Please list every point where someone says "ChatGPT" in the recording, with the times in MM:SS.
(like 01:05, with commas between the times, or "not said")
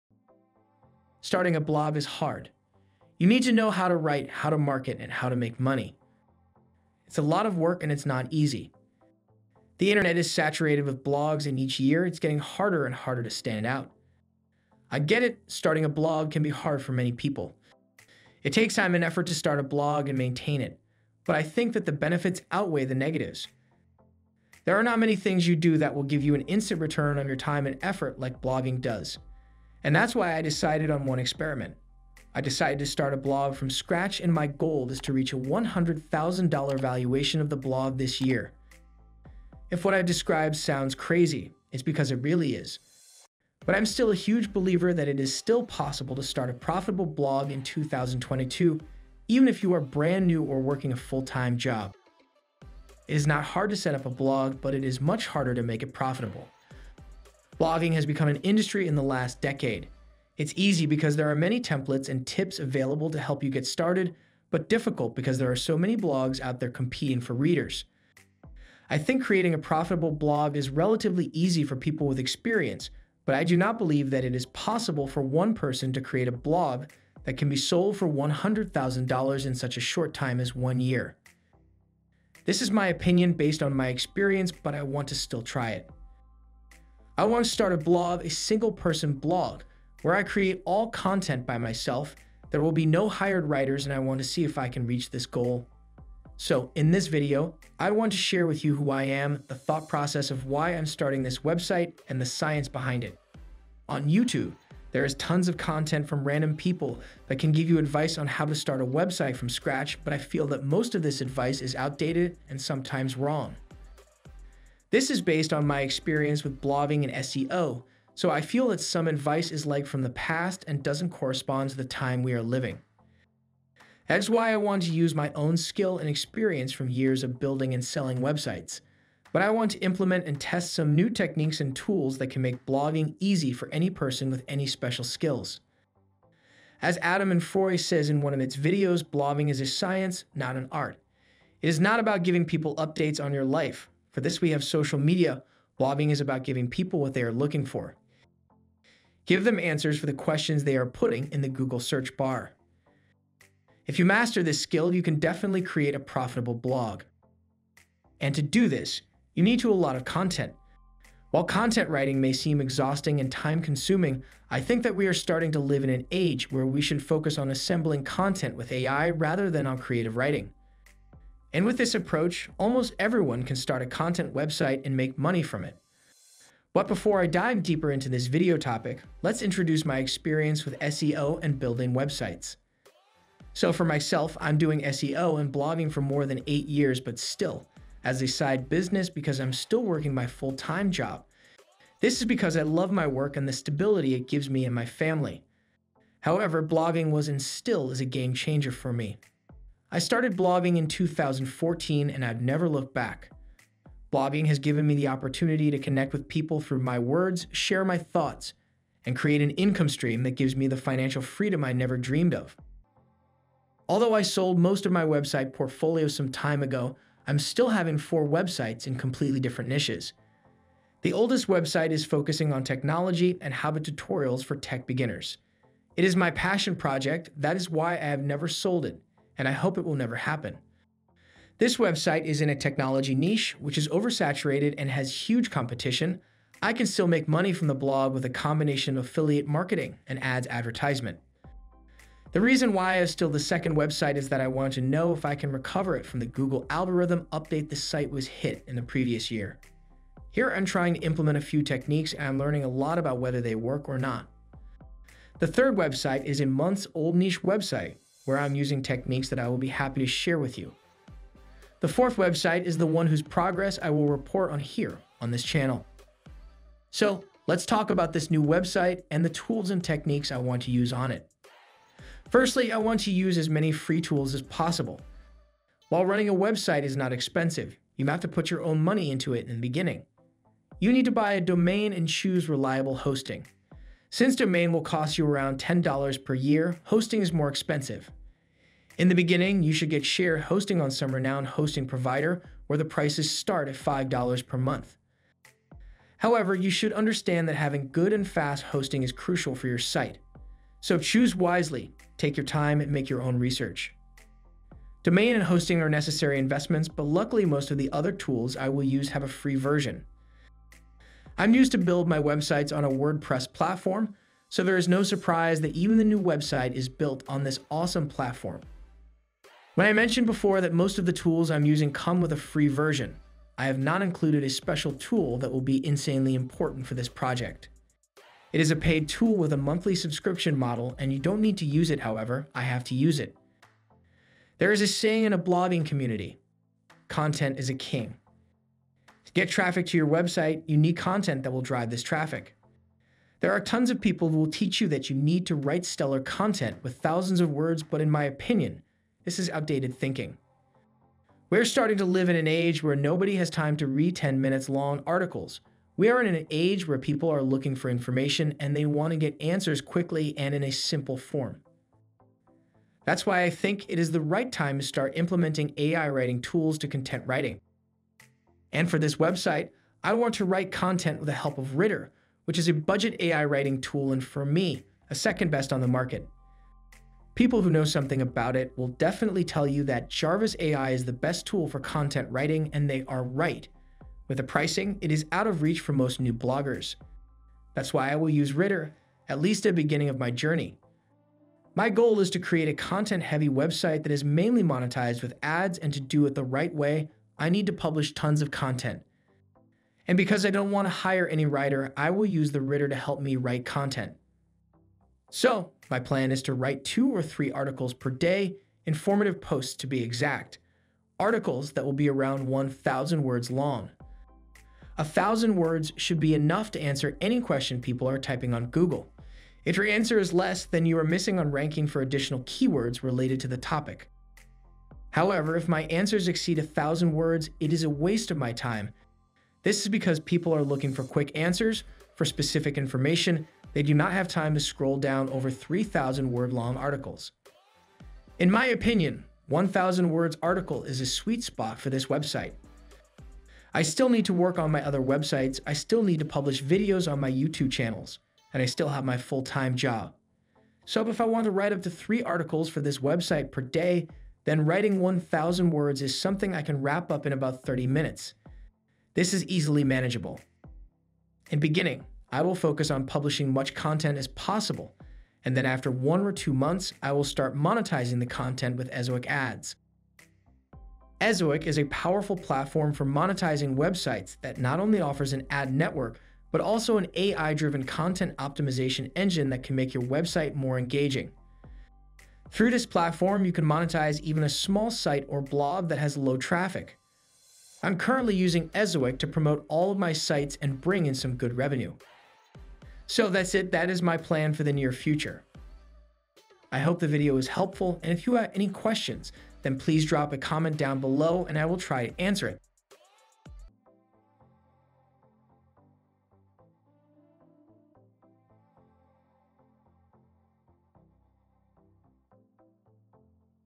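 not said.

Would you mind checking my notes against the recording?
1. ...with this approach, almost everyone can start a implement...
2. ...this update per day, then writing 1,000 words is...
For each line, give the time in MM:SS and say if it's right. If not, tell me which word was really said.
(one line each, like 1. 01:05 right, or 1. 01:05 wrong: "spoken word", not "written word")
1. 02:51 wrong: "content", not "implement"
2. 07:32 wrong: "website", not "update".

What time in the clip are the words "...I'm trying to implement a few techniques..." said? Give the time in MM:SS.
04:10.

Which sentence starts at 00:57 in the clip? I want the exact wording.
Blogging has become an industry in the last decade.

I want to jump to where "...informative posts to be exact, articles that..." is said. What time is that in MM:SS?
06:48.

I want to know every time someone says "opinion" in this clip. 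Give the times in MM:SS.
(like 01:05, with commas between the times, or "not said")
01:22, 05:48, 07:18.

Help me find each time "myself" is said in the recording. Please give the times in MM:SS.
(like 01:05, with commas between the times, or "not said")
01:31, 03:03.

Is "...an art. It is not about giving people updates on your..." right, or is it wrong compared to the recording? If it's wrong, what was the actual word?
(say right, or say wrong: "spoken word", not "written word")
right.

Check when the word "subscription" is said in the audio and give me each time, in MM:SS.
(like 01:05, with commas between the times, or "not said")
05:29.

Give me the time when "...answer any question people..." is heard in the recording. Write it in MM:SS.
06:56.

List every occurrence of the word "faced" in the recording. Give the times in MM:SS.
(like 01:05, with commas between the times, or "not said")
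not said.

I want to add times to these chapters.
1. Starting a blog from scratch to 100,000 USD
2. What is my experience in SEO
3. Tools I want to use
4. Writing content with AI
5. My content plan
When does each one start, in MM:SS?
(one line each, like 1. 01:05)
1. 00:50
2. 02:50
3. 04:25
4. 05:12
5. 06:42.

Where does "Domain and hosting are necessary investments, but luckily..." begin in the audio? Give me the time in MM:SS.
05:05.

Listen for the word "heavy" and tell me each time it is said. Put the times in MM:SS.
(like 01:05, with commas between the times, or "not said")
06:32.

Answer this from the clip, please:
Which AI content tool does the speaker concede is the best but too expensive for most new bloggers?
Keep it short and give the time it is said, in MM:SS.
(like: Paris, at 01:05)
Jarvis AI, at 06:20.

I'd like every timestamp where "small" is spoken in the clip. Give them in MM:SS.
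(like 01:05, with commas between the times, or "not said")
08:04.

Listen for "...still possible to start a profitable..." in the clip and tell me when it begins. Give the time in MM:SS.
00:45.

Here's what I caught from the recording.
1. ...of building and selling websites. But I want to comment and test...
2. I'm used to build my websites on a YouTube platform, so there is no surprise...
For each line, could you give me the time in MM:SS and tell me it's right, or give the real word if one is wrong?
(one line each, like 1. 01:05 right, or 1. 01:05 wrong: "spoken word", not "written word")
1. 02:07 wrong: "implement", not "comment"
2. 05:11 wrong: "WordPress", not "YouTube".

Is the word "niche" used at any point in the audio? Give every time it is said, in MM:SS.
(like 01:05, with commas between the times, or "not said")
03:39, 03:53, 04:17.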